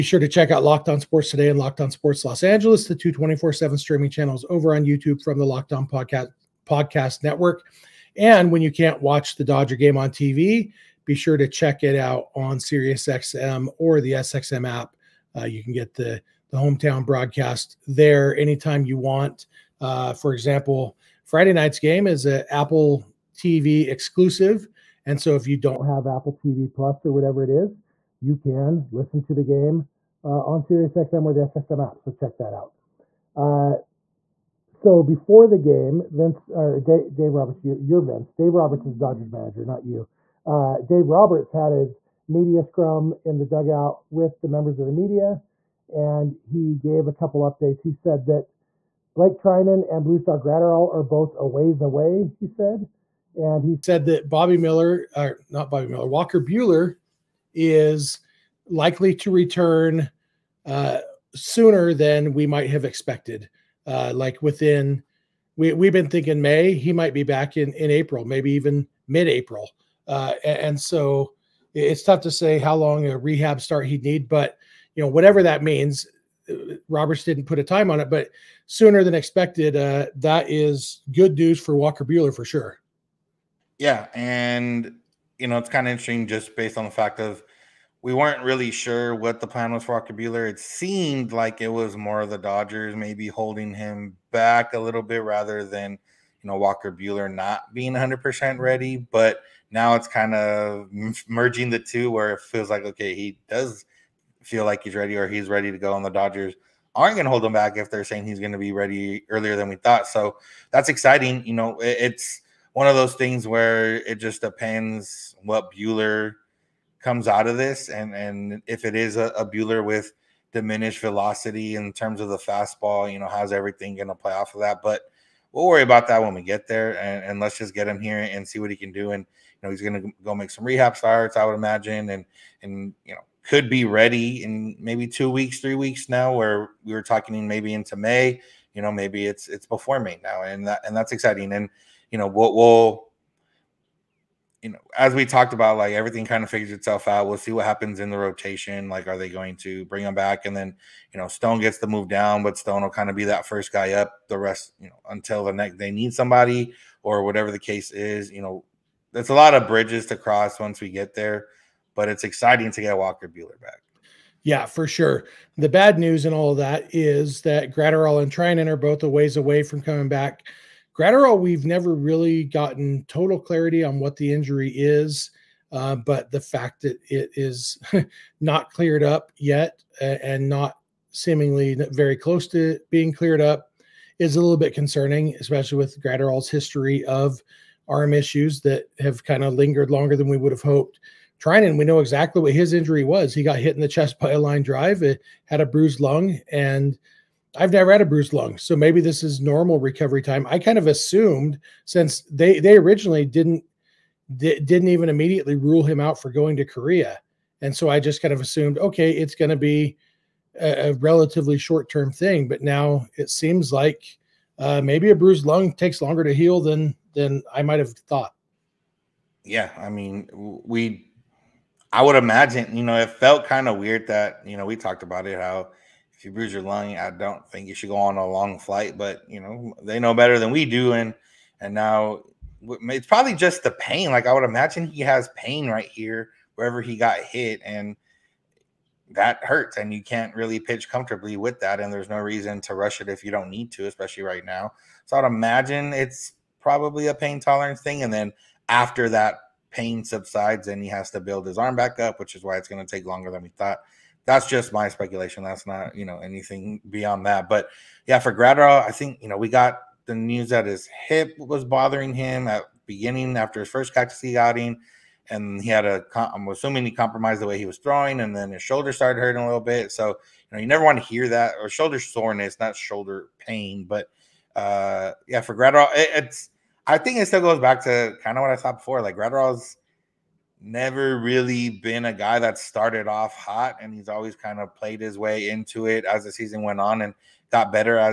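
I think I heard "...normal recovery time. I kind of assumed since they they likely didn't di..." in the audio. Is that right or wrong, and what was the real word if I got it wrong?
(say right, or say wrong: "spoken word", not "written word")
wrong: "originally", not "likely".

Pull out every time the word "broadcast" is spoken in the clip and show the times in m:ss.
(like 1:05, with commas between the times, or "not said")
0:17.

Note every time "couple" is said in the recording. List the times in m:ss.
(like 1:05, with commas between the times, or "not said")
0:47.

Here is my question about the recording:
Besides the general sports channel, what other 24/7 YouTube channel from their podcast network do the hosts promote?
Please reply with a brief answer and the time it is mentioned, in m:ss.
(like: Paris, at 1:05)
Locked On Sports Los Angeles, at 0:01.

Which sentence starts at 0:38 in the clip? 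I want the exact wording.
Dave Roberts is Dodgers manager, not you.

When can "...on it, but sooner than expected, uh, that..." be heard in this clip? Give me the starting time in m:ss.
1:17.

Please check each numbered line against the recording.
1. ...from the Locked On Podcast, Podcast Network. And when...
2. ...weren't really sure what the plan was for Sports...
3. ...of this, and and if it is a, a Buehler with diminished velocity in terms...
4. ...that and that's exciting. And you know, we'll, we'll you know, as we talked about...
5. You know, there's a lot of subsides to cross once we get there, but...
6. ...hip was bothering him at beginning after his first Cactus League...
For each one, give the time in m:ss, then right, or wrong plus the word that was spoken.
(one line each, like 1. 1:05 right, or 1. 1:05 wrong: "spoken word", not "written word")
1. 0:05 right
2. 1:28 wrong: "Walker", not "Sports"
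3. 1:57 right
4. 2:20 right
5. 2:38 wrong: "bridges", not "subsides"
6. 4:21 right.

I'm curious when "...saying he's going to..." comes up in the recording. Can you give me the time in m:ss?
1:48.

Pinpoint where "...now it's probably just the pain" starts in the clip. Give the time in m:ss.
3:51.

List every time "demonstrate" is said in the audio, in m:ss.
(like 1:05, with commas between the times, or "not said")
not said.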